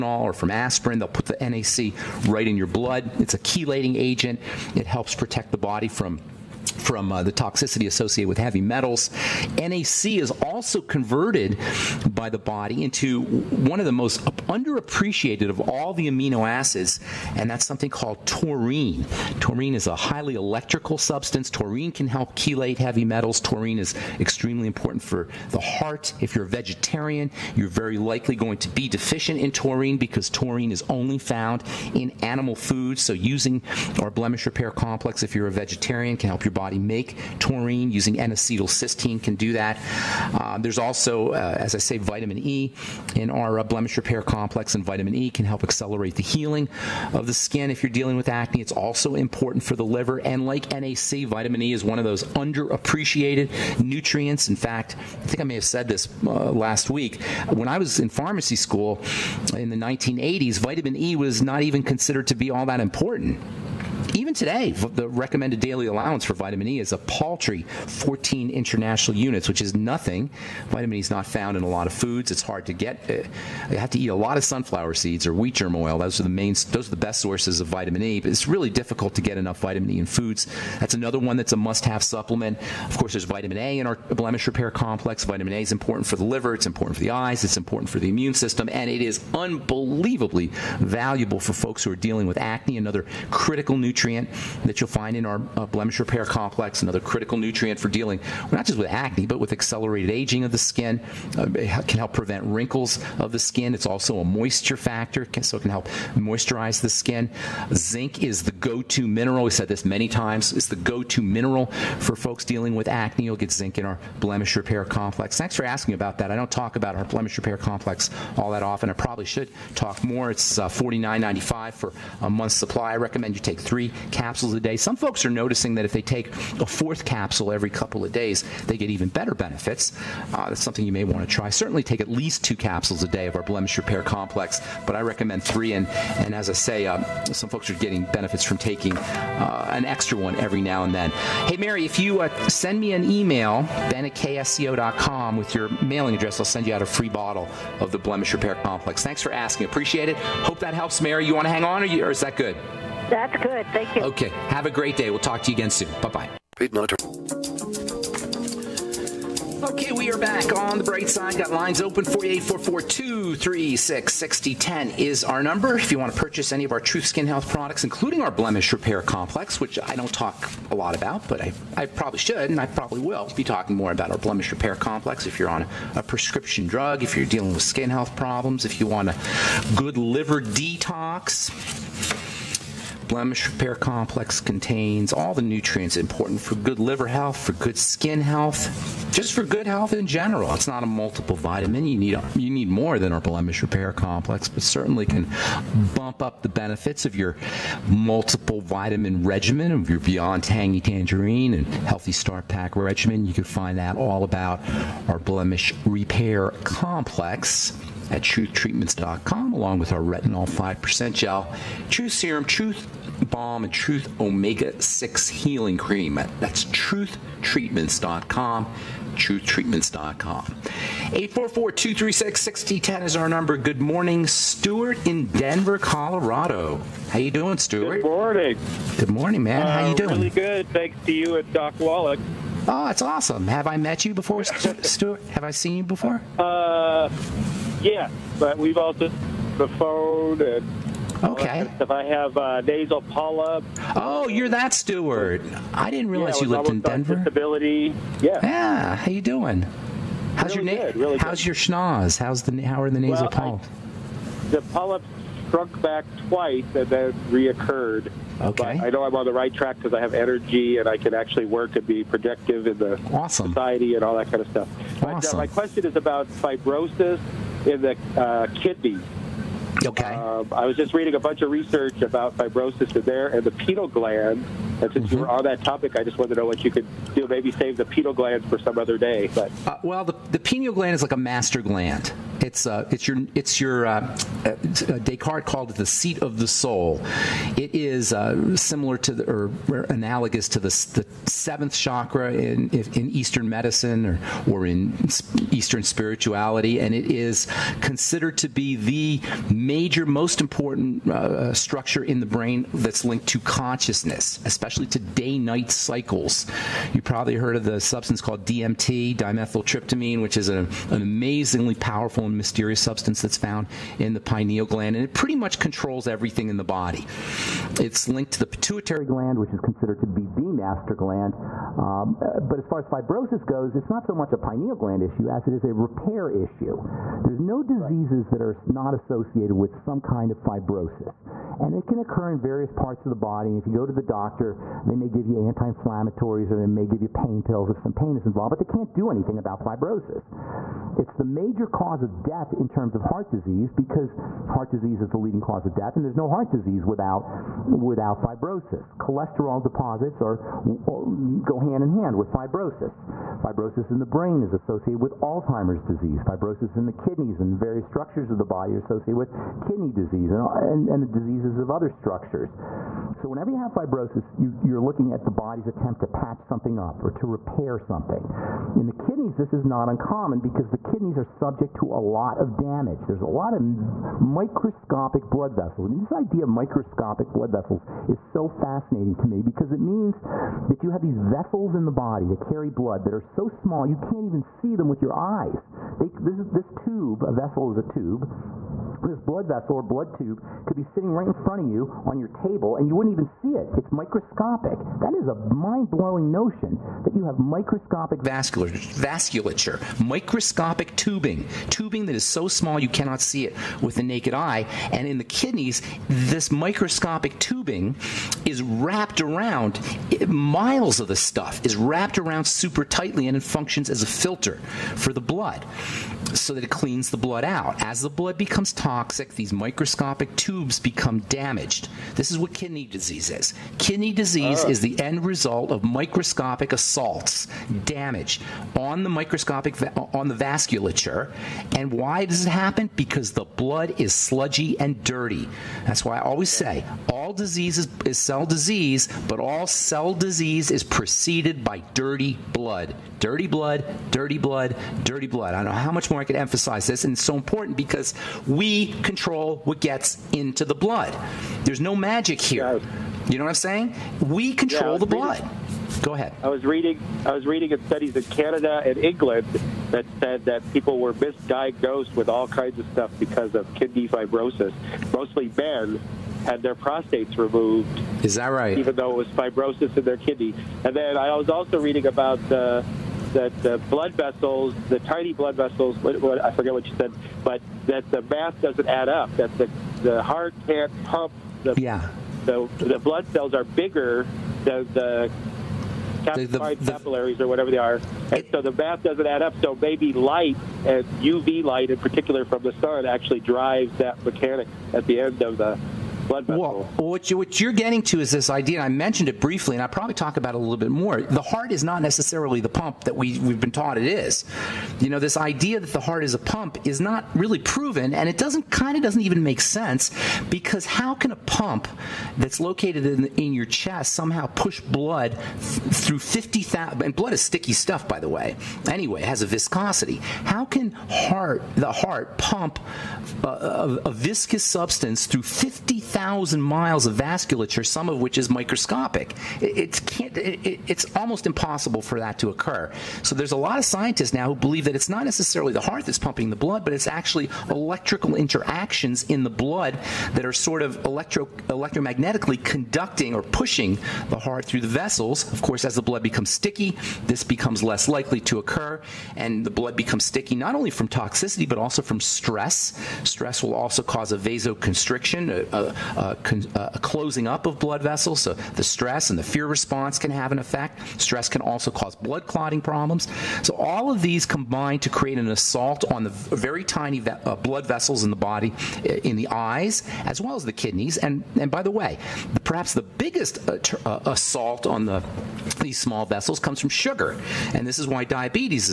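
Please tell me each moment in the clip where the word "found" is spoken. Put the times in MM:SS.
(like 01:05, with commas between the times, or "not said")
00:31, 01:11, 05:13.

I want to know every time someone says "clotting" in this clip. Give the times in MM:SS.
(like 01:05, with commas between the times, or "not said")
09:22.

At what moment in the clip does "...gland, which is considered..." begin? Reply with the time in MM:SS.
05:19.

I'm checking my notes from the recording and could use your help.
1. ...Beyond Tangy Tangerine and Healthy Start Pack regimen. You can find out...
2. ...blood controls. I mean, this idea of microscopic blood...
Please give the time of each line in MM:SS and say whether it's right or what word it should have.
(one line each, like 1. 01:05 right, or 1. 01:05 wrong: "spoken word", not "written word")
1. 03:19 right
2. 06:15 wrong: "vessels", not "controls".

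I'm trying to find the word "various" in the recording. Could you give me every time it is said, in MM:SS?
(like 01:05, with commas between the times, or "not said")
05:32, 05:57.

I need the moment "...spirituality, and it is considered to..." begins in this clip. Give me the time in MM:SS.
04:55.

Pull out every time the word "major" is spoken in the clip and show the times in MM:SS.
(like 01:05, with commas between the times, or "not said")
04:59, 05:41.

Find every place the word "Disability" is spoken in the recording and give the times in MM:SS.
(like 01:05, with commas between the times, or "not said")
04:07.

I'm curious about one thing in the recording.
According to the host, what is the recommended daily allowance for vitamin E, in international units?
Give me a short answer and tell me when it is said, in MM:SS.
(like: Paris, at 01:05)
14, at 01:06.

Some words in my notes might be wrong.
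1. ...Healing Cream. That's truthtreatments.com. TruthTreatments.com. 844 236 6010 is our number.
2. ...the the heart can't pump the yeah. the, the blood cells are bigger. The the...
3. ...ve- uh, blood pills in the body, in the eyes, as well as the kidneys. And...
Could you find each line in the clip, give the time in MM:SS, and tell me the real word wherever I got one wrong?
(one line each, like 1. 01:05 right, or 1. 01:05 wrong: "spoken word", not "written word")
1. 03:35 right
2. 07:59 right
3. 09:27 wrong: "vessels", not "pills".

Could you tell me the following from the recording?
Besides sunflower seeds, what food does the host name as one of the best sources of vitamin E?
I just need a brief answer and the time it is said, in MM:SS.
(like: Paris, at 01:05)
wheat germ oil, at 01:15.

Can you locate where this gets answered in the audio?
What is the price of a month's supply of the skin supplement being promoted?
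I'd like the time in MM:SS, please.
02:00.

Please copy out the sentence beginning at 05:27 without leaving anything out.
There's no diseases that are not associated associated with some kind of fibrosis.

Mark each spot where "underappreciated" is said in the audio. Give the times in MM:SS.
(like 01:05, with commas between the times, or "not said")
00:14, 00:52.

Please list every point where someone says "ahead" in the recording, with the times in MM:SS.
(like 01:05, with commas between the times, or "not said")
07:36.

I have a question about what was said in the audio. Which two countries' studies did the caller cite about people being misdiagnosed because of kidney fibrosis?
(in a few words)
Canada and England.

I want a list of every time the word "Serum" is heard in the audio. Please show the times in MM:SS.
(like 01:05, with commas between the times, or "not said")
03:32.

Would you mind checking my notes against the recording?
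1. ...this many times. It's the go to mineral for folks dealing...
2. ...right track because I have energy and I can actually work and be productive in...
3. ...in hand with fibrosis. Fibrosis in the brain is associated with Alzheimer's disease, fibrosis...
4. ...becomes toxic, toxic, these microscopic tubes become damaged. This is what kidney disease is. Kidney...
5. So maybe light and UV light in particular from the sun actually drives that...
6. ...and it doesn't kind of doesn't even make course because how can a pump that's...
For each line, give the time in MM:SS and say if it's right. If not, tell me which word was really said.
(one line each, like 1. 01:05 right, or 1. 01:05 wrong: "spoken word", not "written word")
1. 01:49 right
2. 04:19 right
3. 05:51 right
4. 06:58 right
5. 08:09 right
6. 08:28 wrong: "sense", not "course".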